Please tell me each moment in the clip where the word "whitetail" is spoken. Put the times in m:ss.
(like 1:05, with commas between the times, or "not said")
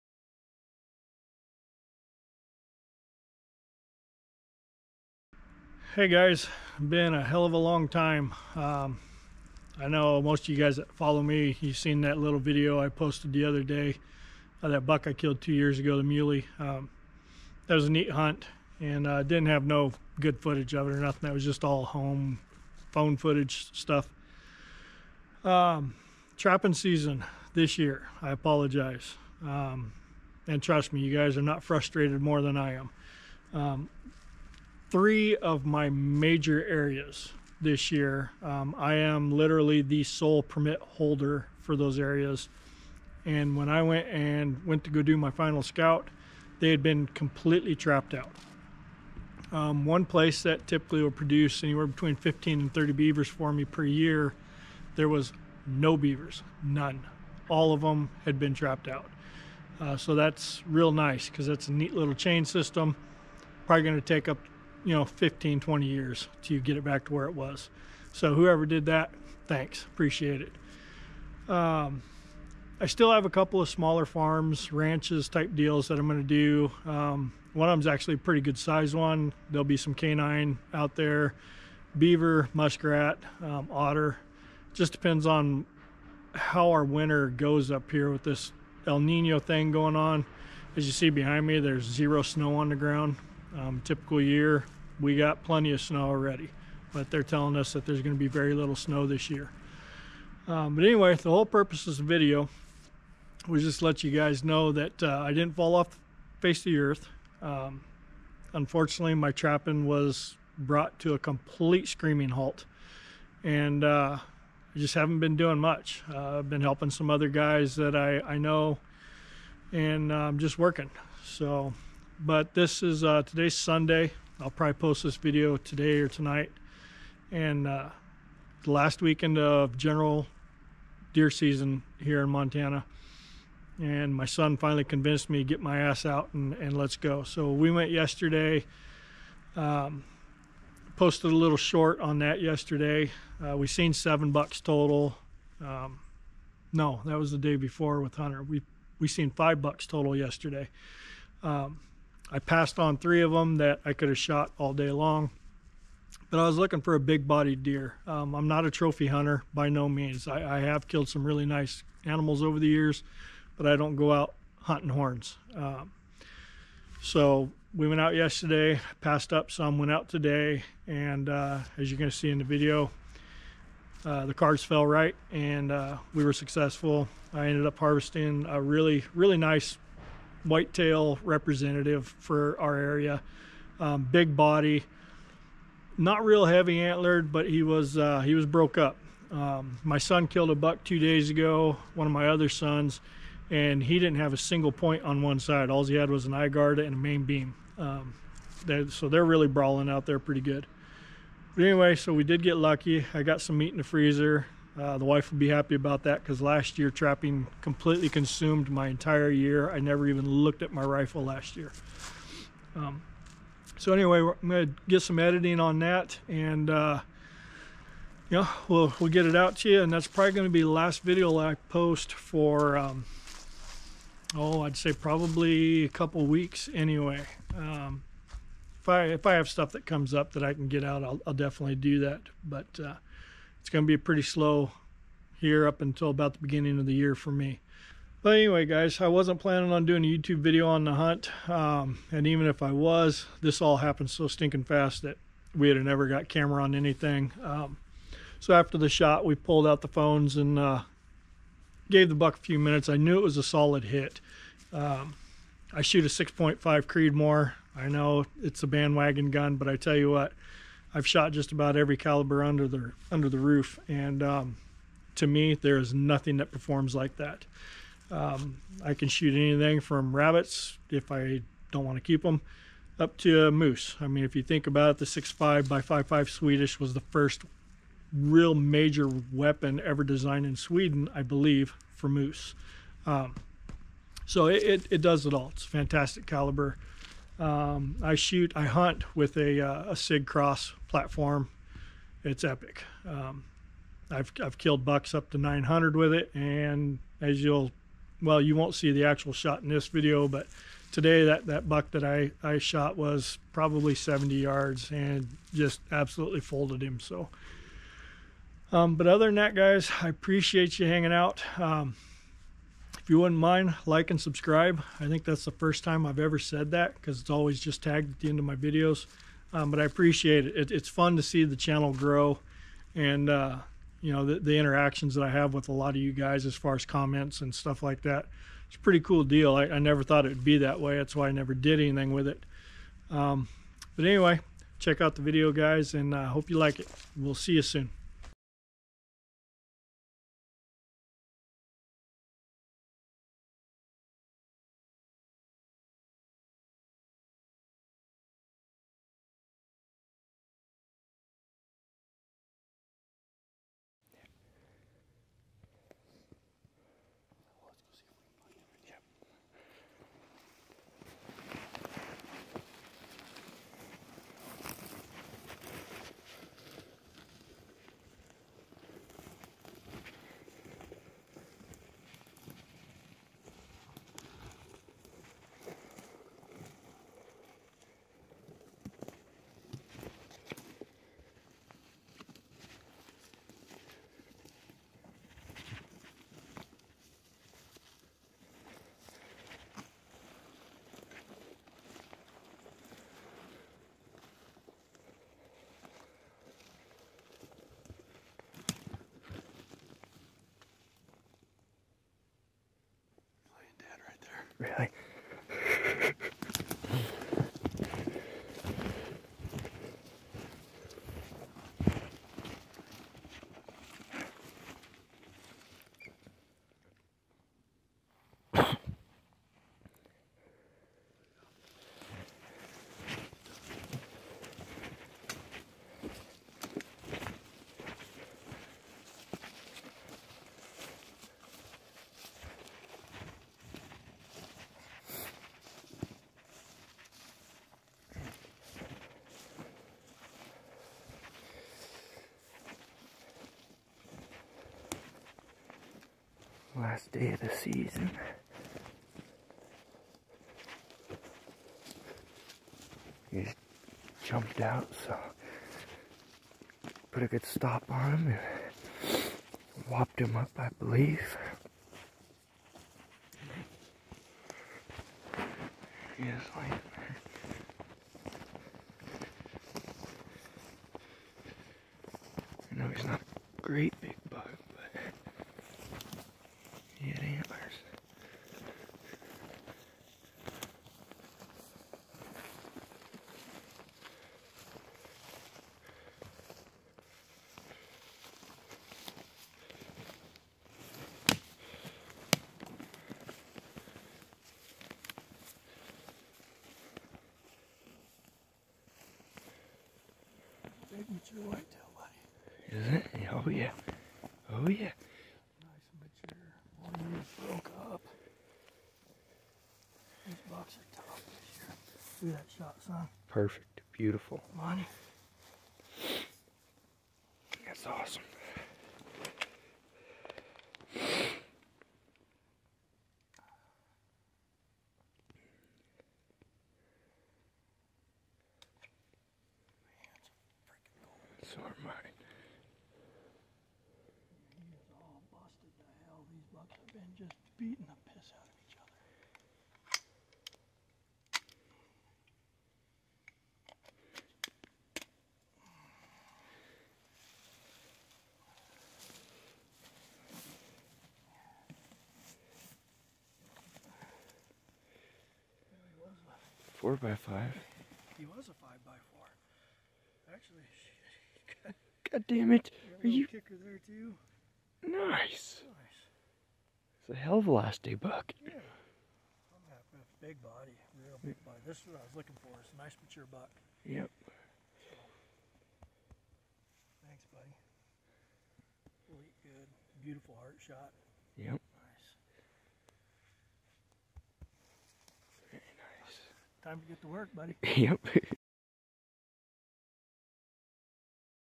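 3:00, 8:21.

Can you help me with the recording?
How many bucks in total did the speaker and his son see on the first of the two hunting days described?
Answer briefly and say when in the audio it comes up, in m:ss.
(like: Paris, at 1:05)
5, at 2:29.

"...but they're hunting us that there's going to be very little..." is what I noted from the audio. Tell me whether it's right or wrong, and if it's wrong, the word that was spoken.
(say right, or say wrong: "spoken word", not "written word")
wrong: "telling", not "hunting".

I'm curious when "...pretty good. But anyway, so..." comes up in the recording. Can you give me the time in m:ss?
3:20.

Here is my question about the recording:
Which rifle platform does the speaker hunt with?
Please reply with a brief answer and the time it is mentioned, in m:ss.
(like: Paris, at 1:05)
Sig Cross, at 4:49.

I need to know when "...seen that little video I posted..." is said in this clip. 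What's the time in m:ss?
0:11.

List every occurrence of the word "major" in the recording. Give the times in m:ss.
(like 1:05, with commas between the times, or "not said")
0:35, 4:38.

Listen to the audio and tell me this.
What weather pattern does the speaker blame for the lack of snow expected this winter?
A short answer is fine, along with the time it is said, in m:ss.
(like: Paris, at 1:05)
El Nino, at 1:28.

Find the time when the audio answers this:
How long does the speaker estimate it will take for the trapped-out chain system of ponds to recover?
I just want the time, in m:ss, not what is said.
1:05.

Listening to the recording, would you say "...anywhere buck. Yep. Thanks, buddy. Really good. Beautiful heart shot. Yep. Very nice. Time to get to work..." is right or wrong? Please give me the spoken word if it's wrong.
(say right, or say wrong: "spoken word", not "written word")
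wrong: "mature", not "anywhere".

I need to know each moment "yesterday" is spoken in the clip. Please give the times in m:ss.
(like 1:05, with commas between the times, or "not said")
2:17, 2:22, 2:30, 2:48.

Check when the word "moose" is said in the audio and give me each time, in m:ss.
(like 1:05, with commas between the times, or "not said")
4:33, 4:42.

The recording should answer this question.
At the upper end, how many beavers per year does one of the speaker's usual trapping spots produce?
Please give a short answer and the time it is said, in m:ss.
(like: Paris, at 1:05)
30, at 0:52.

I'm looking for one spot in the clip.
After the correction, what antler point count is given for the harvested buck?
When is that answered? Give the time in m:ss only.
9:18.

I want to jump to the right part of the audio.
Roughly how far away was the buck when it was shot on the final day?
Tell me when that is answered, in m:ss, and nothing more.
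5:03.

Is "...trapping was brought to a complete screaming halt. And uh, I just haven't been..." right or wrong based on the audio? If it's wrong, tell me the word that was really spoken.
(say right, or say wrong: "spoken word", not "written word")
right.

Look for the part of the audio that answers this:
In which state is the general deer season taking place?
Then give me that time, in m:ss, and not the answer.
2:12.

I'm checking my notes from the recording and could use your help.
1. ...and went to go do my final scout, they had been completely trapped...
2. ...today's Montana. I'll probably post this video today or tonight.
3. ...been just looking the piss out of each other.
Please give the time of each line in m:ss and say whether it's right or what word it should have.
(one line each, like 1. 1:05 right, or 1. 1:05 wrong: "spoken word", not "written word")
1. 0:44 right
2. 2:03 wrong: "Sunday", not "Montana"
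3. 8:56 wrong: "beating", not "looking".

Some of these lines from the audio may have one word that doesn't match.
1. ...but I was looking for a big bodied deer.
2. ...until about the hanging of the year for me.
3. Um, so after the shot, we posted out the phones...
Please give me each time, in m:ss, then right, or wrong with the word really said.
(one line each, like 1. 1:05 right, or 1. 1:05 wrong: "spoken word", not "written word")
1. 2:36 right
2. 3:55 wrong: "beginning", not "hanging"
3. 4:07 wrong: "pulled", not "posted".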